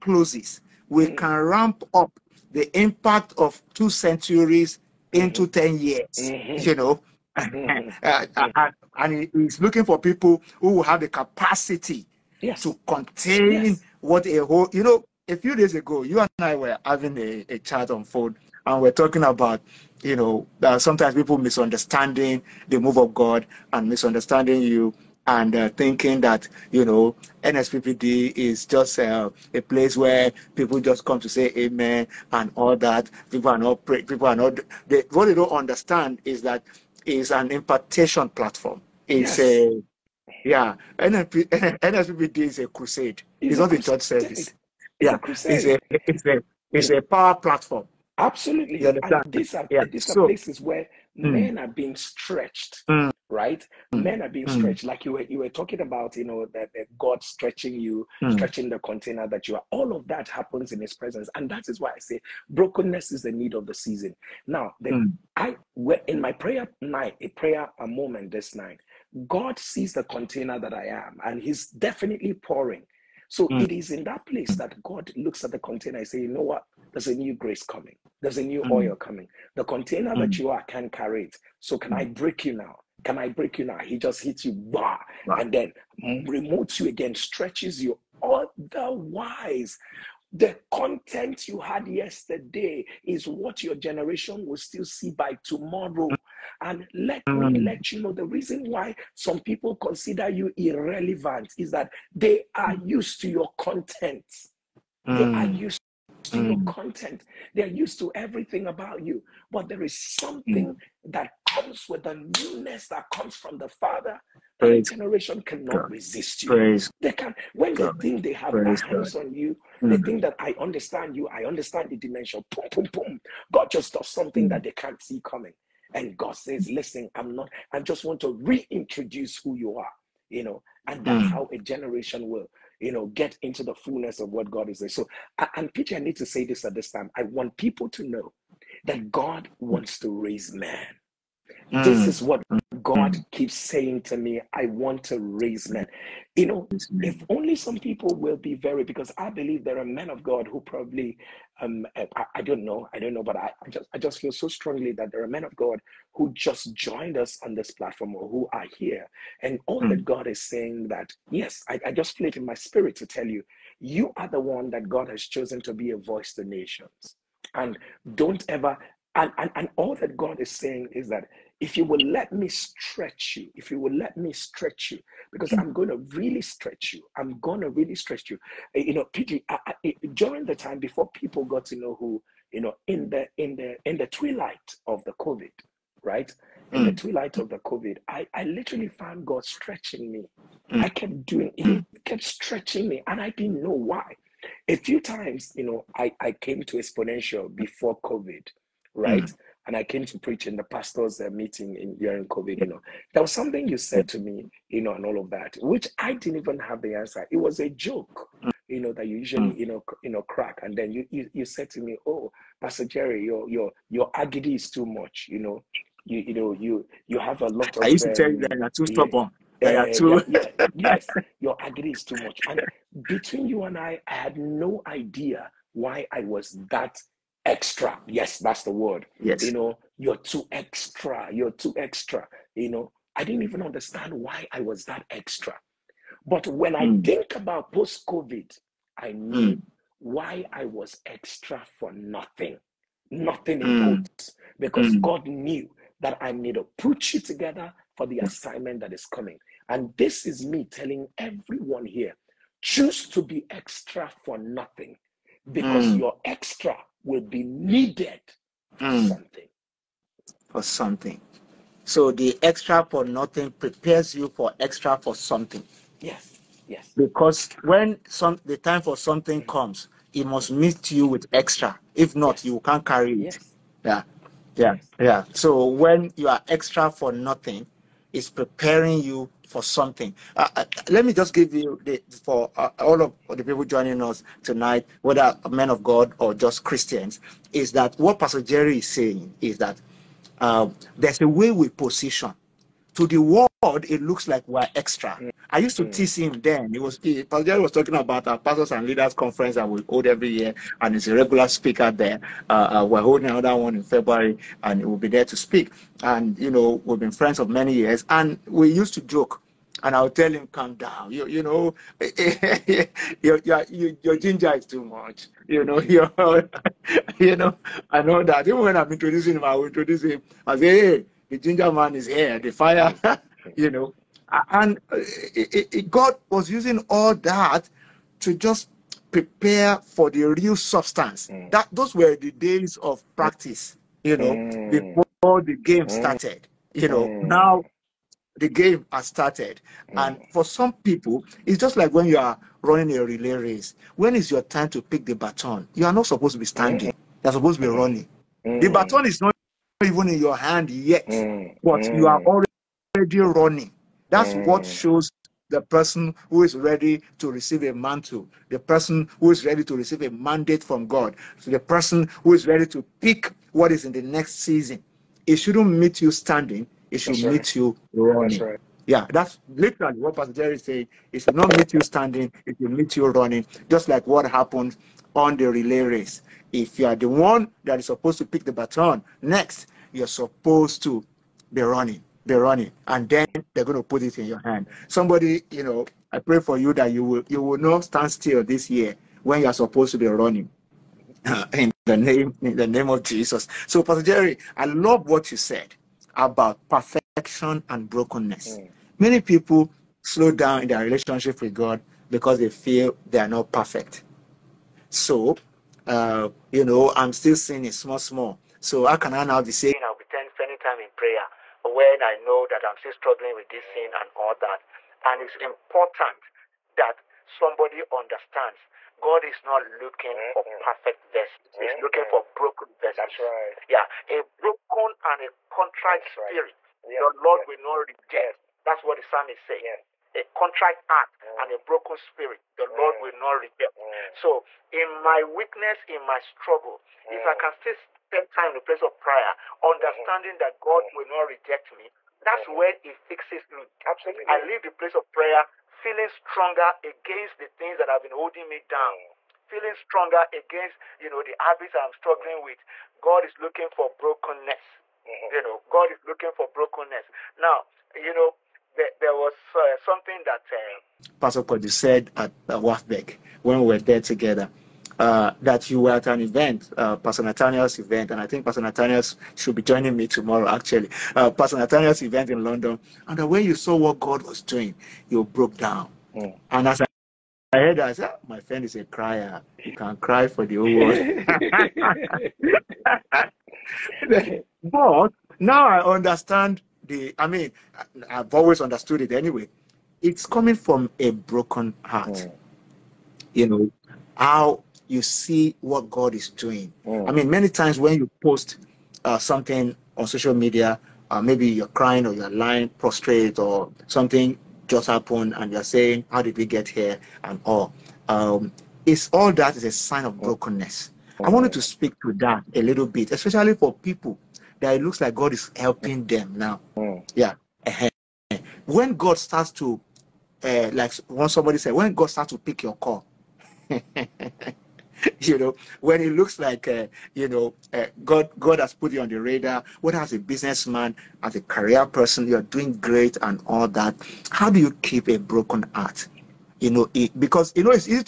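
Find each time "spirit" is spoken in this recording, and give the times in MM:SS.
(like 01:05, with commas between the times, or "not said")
02:42, 07:06, 07:11.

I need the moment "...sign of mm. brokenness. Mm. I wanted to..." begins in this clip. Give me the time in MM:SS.
08:29.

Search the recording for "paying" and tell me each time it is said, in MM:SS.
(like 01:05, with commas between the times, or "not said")
not said.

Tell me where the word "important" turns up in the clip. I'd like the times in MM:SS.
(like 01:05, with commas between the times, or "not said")
04:03, 06:55.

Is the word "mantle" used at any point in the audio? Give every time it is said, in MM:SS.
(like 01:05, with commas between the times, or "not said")
05:57.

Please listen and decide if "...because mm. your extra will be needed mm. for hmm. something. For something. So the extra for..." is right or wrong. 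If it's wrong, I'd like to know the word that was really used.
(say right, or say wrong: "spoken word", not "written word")
right.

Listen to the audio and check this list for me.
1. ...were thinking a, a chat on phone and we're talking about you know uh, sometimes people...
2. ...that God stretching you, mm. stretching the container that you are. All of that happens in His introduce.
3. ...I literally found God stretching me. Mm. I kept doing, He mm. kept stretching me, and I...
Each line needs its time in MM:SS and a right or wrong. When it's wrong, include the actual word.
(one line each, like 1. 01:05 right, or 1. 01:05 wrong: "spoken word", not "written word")
1. 00:16 wrong: "having", not "thinking"
2. 00:56 wrong: "presence", not "introduce"
3. 03:08 right.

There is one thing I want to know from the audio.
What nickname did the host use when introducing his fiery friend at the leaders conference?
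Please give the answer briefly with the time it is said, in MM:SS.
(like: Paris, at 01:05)
the ginger man, at 05:21.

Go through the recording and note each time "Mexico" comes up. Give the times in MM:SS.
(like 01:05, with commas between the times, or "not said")
not said.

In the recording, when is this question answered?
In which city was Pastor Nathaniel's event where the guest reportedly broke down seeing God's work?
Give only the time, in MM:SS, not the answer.
07:52.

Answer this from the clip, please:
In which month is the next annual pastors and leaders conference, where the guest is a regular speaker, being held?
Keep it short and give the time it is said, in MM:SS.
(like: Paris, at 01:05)
February, at 05:03.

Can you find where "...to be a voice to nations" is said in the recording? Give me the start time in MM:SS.
02:45.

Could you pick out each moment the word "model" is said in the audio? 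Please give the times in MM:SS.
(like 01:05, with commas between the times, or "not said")
not said.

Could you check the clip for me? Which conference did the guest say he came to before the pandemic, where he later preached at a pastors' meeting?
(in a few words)
Exponential.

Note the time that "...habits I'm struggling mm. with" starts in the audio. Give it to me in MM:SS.
07:31.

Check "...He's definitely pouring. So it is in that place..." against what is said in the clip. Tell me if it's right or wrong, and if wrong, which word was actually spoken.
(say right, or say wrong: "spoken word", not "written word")
right.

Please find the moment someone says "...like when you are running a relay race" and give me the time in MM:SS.
05:41.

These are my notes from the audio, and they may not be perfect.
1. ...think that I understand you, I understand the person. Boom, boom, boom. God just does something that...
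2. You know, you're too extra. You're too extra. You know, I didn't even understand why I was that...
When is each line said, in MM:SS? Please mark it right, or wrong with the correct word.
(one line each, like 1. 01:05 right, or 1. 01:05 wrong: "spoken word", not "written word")
1. 01:59 wrong: "dimension", not "person"
2. 03:49 right.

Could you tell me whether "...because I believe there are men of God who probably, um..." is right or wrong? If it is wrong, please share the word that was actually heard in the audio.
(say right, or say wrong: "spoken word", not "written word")
right.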